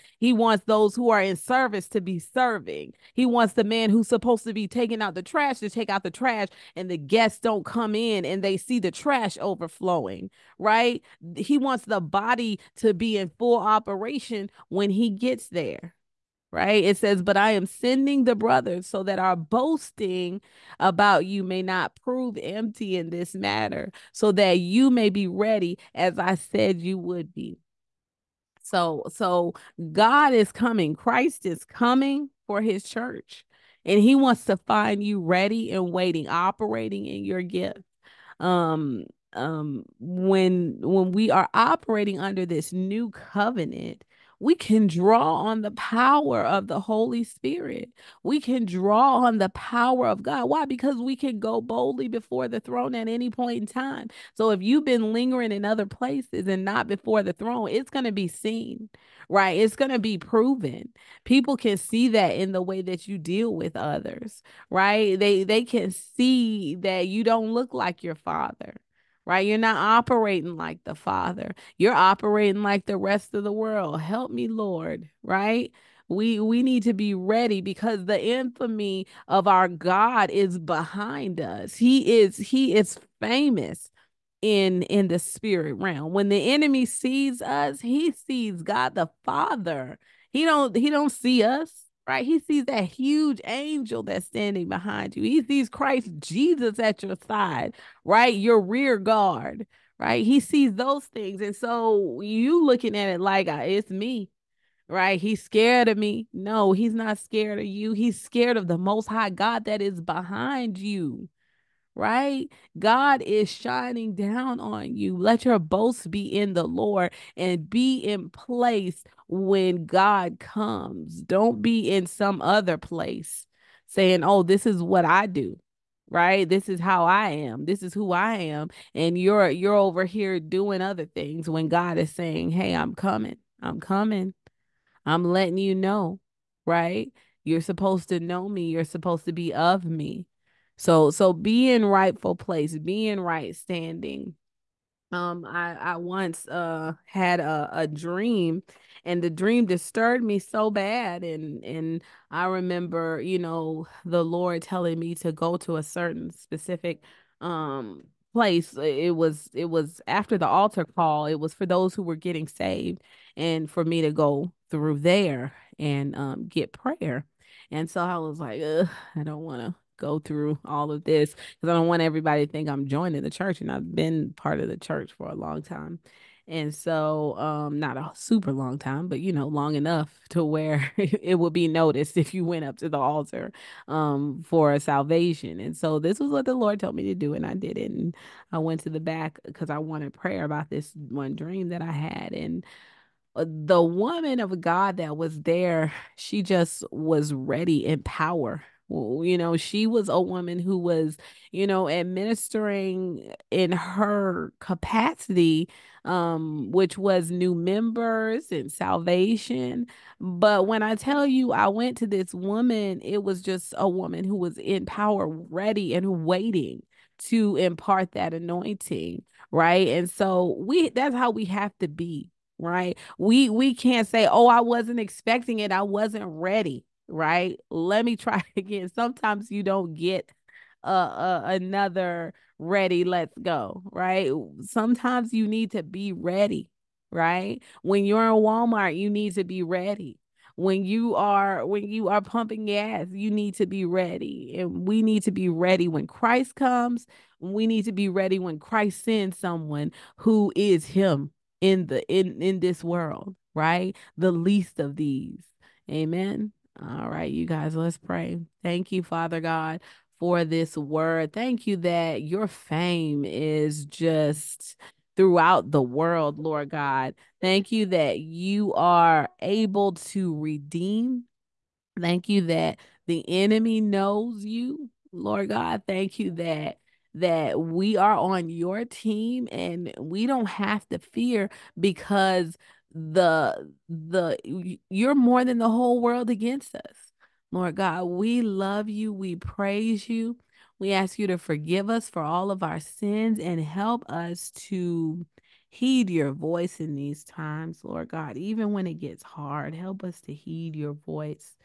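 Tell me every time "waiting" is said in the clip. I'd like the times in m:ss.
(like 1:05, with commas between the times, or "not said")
0:35, 3:36.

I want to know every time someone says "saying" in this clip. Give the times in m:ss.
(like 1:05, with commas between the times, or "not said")
2:03, 2:12.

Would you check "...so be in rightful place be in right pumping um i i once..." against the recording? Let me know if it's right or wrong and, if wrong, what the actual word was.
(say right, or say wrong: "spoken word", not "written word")
wrong: "standing", not "pumping".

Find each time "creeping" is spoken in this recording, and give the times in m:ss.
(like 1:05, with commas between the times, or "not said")
not said.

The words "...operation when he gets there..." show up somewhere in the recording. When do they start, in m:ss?
0:13.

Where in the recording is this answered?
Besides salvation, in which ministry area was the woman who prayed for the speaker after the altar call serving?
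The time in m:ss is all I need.
3:27.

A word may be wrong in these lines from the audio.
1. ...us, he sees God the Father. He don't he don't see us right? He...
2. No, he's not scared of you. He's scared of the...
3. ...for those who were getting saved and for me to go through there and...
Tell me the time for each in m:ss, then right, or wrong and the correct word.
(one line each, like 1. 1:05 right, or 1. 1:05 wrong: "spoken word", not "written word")
1. 1:27 right
2. 1:46 right
3. 2:41 right.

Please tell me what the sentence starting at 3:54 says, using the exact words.
Sometimes you need to be ready, right?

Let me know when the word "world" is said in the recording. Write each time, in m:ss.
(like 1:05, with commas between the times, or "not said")
1:13, 4:12, 4:25, 4:46.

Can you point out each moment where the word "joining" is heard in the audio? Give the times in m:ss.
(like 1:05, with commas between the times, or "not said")
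2:52.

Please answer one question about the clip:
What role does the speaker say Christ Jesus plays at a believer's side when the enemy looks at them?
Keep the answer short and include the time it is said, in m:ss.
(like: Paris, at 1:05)
Rear guard, at 1:38.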